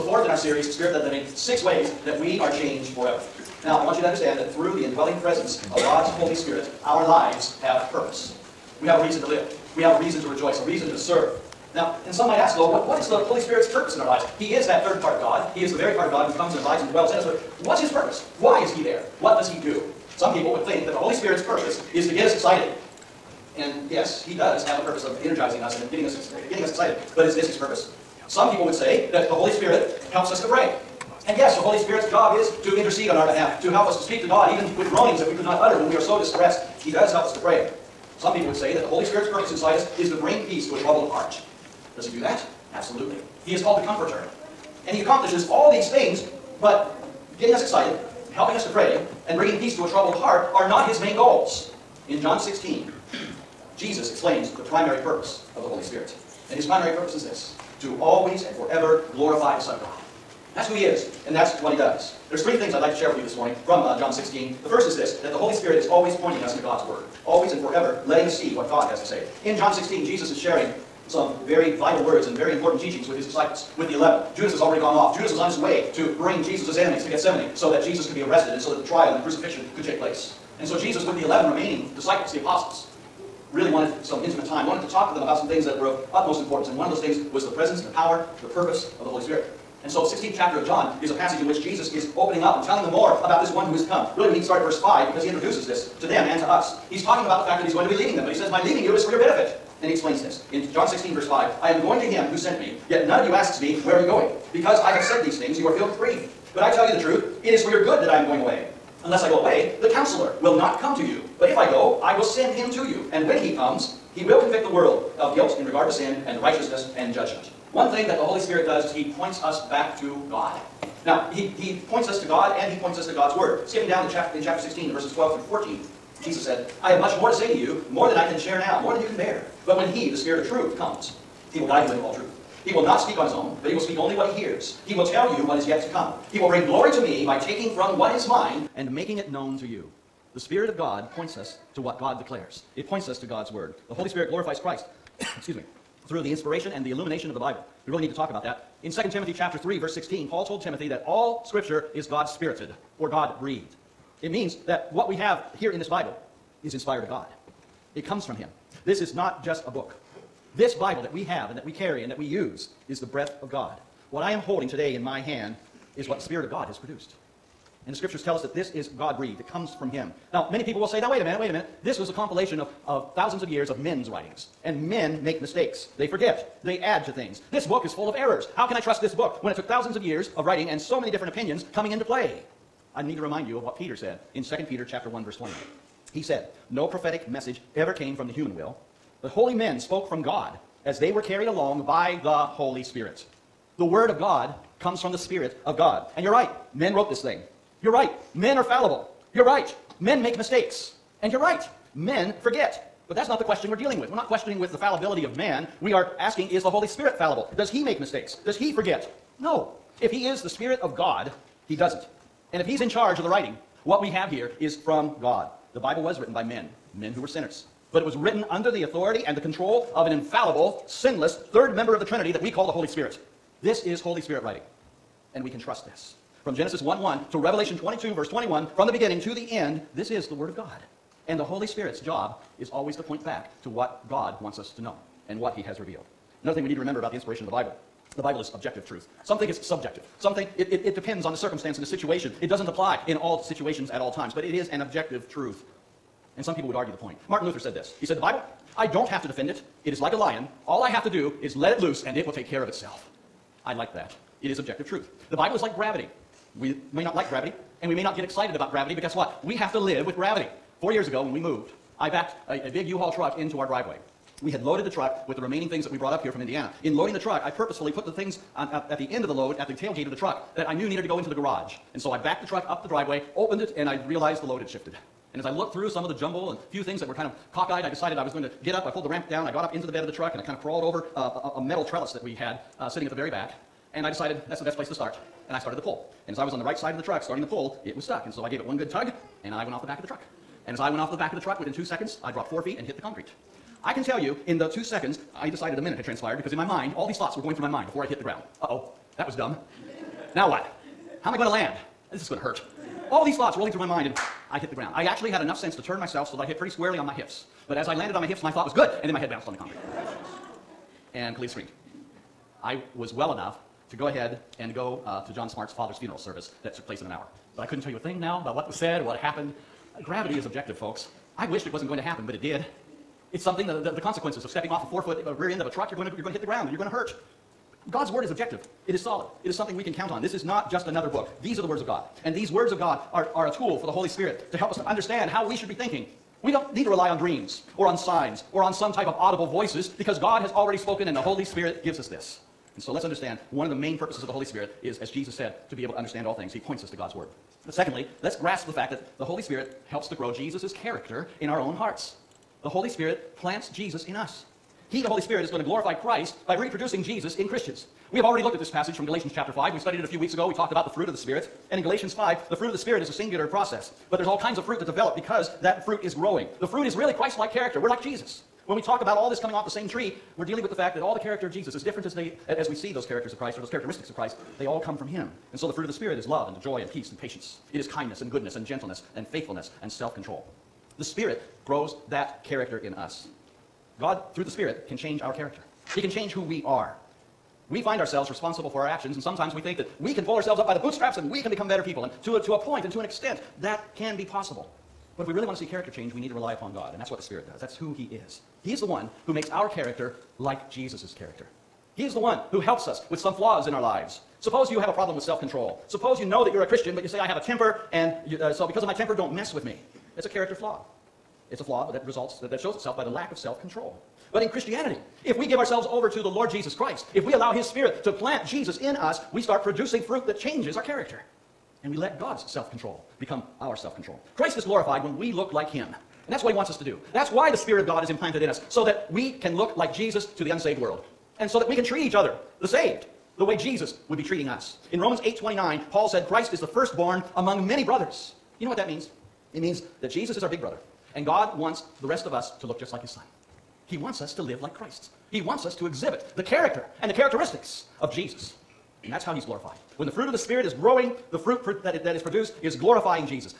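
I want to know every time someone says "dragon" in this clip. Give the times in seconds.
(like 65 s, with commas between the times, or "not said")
not said.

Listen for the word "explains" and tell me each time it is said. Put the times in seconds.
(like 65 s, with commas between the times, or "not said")
54 s, 99 s.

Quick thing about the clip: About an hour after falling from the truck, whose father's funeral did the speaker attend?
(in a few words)
John Smart's.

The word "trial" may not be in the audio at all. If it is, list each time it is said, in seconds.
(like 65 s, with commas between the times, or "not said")
78 s.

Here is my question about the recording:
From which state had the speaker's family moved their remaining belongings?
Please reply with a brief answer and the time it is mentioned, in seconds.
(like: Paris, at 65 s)
Indiana, at 266 s.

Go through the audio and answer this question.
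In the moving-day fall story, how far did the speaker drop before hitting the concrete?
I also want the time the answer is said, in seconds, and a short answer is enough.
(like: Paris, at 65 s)
4 feet, at 292 s.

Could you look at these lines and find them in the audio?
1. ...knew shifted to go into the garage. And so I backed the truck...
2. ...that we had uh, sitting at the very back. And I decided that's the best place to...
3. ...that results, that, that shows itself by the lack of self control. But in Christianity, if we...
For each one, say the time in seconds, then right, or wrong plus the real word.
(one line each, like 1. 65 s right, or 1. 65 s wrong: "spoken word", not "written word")
1. 270 s wrong: "needed", not "shifted"
2. 282 s right
3. 411 s right.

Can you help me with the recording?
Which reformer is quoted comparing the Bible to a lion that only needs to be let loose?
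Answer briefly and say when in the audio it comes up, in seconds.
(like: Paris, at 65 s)
Martin Luther, at 247 s.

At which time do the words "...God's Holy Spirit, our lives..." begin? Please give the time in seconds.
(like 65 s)
5 s.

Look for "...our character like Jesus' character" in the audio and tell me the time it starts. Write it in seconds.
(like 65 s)
399 s.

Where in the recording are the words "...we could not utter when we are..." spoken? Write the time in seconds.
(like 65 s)
35 s.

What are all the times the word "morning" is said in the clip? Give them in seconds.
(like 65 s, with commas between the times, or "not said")
63 s.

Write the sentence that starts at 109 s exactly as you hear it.
Unless I go away, the counselor will not come to you.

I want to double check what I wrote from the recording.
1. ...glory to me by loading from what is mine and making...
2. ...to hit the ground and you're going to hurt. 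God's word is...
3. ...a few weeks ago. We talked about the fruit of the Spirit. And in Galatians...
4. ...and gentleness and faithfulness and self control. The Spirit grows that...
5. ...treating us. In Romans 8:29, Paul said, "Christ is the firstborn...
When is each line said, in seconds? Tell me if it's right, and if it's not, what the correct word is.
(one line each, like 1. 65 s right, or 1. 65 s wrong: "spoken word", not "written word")
1. 136 s wrong: "taking", not "loading"
2. 326 s right
3. 360 s right
4. 378 s right
5. 434 s right.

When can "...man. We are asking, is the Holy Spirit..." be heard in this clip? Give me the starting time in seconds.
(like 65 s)
205 s.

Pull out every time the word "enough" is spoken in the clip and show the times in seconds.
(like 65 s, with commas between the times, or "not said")
305 s, 313 s.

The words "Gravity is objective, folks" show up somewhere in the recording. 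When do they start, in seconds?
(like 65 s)
320 s.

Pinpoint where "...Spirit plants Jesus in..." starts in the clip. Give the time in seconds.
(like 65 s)
352 s.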